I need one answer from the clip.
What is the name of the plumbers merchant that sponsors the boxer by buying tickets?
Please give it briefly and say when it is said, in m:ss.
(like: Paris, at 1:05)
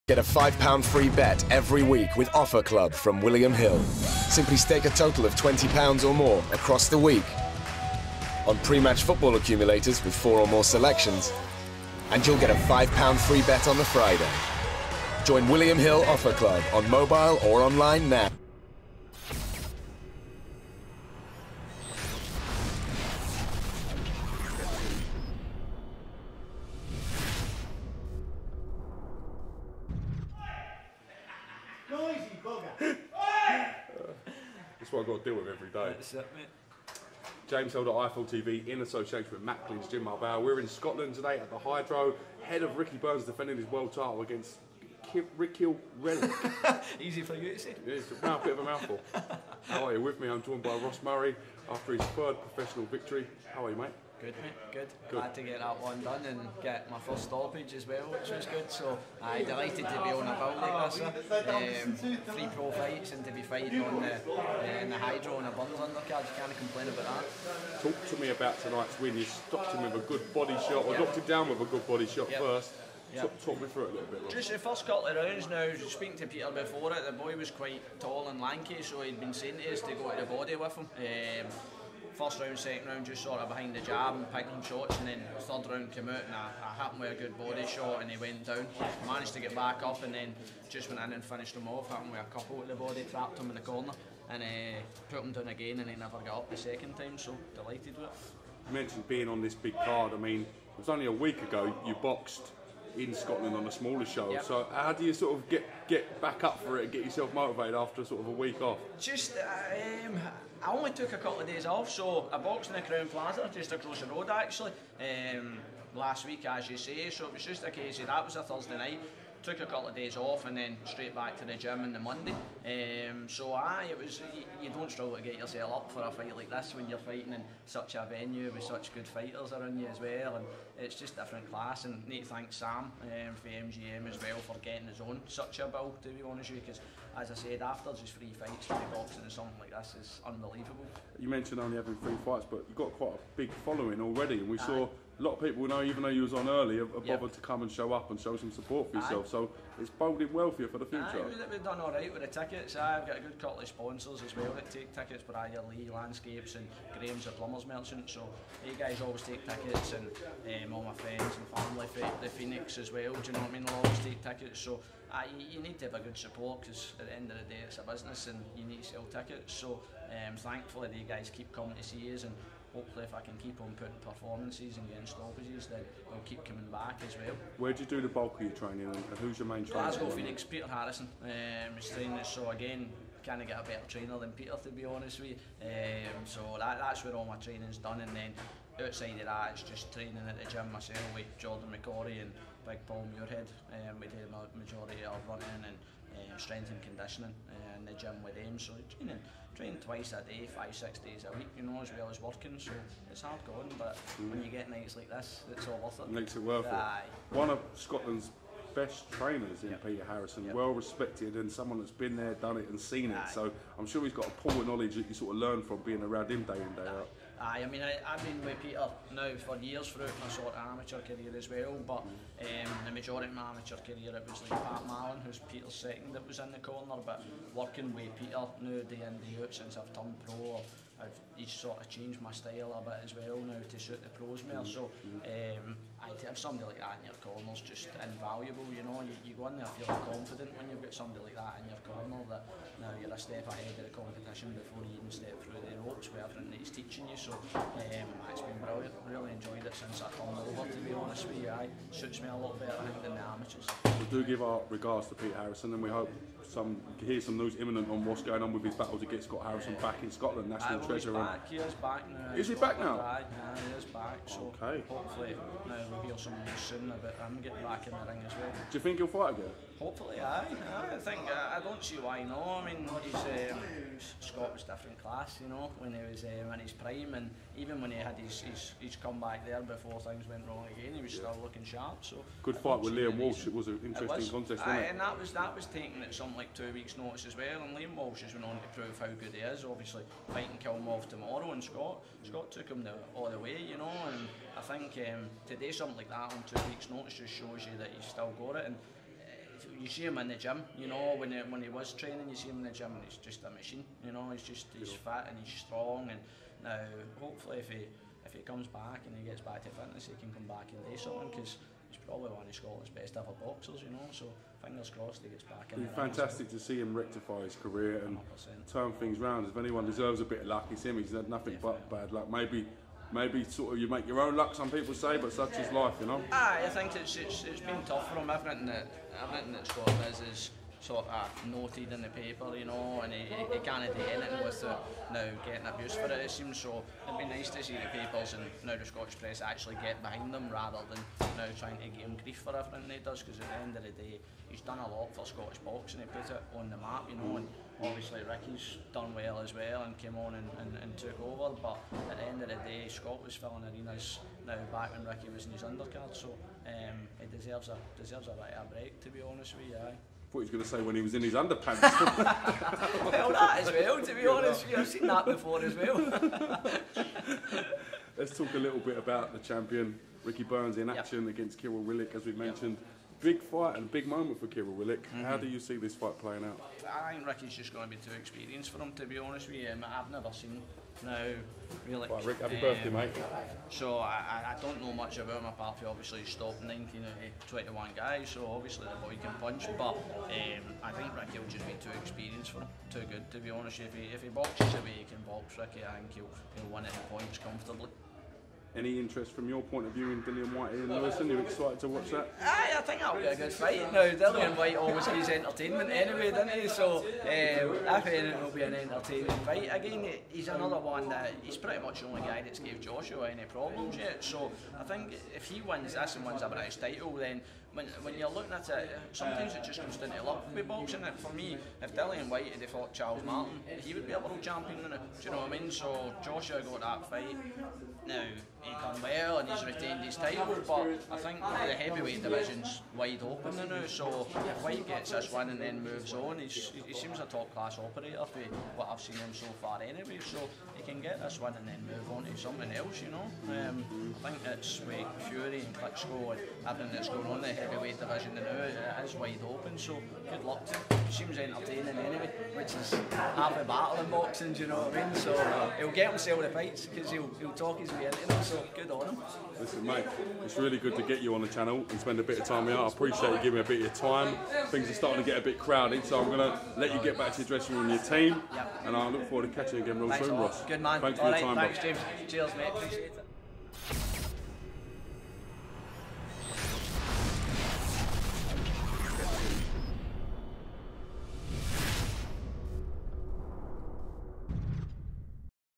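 Graham's, at 2:36.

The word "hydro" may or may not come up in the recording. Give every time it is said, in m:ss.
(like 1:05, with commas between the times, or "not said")
0:41, 1:04.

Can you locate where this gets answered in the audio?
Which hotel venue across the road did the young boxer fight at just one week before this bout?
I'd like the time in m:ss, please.
1:52.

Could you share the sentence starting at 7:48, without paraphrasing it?
and I look forward to catching you again real soon, Ross.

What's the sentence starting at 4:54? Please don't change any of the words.
And I think um, something like that on two weeks' notice just shows you that he's still got it.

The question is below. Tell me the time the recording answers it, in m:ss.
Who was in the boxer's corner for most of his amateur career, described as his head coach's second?
3:44.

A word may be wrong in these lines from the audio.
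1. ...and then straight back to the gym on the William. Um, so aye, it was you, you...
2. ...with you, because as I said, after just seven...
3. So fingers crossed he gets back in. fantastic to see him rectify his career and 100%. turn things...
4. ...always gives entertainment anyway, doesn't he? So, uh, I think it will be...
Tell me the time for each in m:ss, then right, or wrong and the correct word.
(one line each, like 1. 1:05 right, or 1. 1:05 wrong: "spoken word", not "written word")
1. 2:00 wrong: "Monday", not "William"
2. 2:16 wrong: "three", not "seven"
3. 5:14 right
4. 6:44 right.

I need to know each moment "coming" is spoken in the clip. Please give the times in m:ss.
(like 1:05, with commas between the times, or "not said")
2:51, 2:56.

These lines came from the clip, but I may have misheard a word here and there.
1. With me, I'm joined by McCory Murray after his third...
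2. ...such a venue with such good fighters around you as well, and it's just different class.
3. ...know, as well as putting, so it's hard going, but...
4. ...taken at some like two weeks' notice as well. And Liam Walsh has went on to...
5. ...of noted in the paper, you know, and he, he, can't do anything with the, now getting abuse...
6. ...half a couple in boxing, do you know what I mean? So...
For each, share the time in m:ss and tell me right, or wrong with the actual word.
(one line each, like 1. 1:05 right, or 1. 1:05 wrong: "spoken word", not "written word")
1. 0:50 wrong: "Ross", not "McCory"
2. 2:07 right
3. 3:21 wrong: "working", not "putting"
4. 4:45 right
5. 5:31 right
6. 7:33 wrong: "battle", not "couple".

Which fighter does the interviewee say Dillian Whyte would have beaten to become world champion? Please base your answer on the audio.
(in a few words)
Charles Martin.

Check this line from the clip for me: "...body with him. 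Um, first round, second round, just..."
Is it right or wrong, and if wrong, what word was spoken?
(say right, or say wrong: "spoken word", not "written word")
right.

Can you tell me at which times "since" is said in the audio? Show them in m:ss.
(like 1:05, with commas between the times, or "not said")
3:49, 4:09.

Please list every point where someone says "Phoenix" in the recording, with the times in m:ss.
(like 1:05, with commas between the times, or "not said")
2:42, 3:00.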